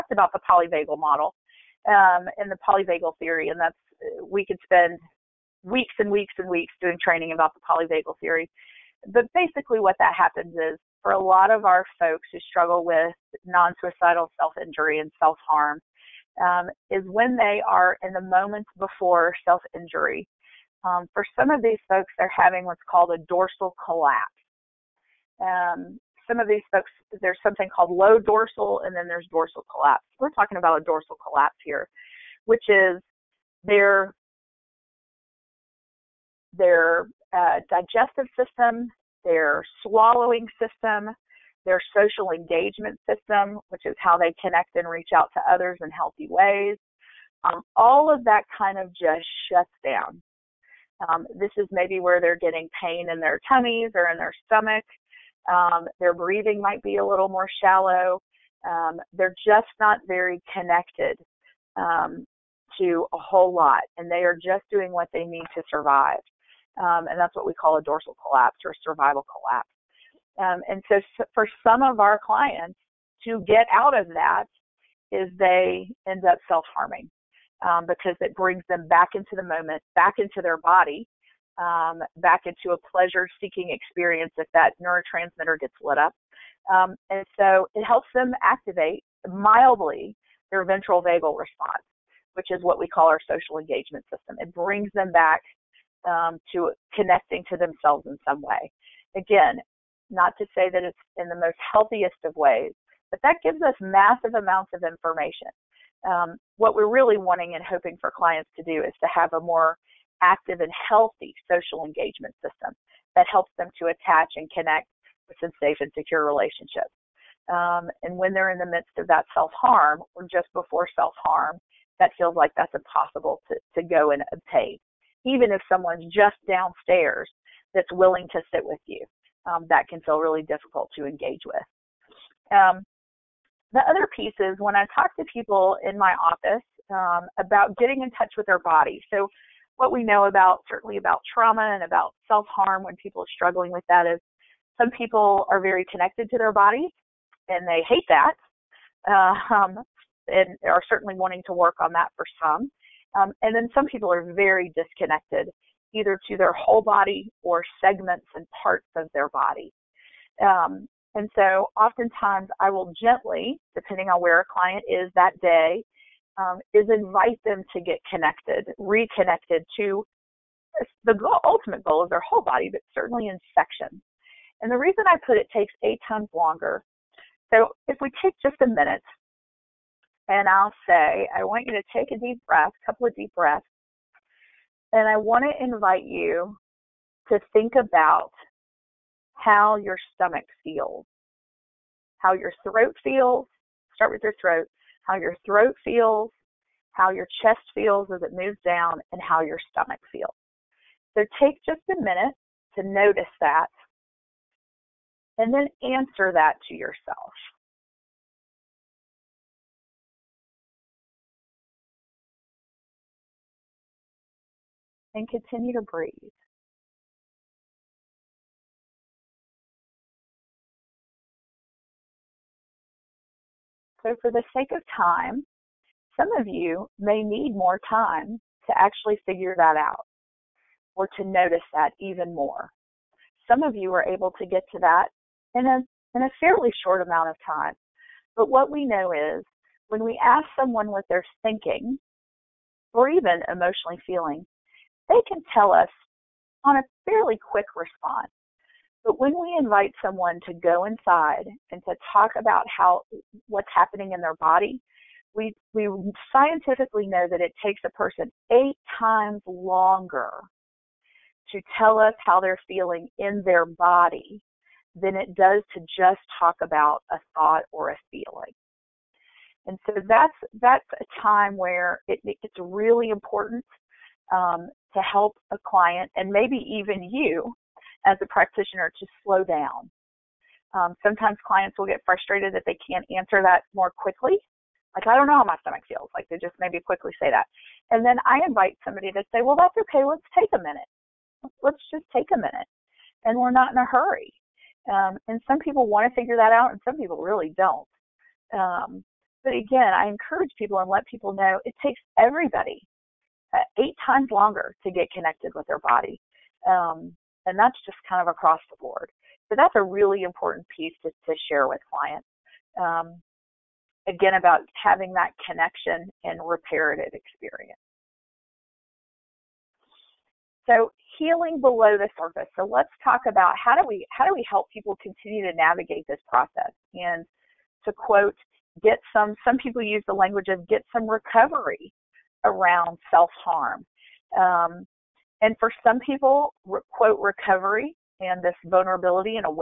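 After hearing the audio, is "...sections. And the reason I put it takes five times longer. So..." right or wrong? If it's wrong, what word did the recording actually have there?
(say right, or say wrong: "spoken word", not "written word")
wrong: "eight", not "five".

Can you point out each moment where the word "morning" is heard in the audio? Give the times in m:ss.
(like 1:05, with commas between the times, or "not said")
not said.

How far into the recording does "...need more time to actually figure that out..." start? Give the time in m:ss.
3:47.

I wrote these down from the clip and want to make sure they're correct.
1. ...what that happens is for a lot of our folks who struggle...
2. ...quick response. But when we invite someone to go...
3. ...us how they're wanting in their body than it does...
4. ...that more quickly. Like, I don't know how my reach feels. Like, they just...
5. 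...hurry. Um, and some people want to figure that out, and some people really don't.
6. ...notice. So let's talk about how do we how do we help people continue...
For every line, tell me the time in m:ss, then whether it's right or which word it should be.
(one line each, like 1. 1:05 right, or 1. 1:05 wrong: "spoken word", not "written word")
1. 0:09 right
2. 4:07 right
3. 4:21 wrong: "feeling", not "wanting"
4. 4:43 wrong: "stomach", not "reach"
5. 4:53 right
6. 5:22 wrong: "surface", not "notice".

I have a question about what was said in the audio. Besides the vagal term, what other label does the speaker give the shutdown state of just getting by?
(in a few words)
survival collapse.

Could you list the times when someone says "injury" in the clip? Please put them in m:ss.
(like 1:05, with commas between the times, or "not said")
0:14, 0:19.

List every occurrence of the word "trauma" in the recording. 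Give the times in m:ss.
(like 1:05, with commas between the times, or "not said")
2:21.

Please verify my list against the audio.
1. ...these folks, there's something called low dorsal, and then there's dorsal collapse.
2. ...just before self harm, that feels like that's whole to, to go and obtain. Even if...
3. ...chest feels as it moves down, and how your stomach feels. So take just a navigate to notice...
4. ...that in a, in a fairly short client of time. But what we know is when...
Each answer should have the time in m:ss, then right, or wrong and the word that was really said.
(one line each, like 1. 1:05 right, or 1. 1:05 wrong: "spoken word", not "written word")
1. 0:26 right
2. 2:00 wrong: "impossible", not "whole"
3. 3:17 wrong: "minute", not "navigate"
4. 3:54 wrong: "amount", not "client".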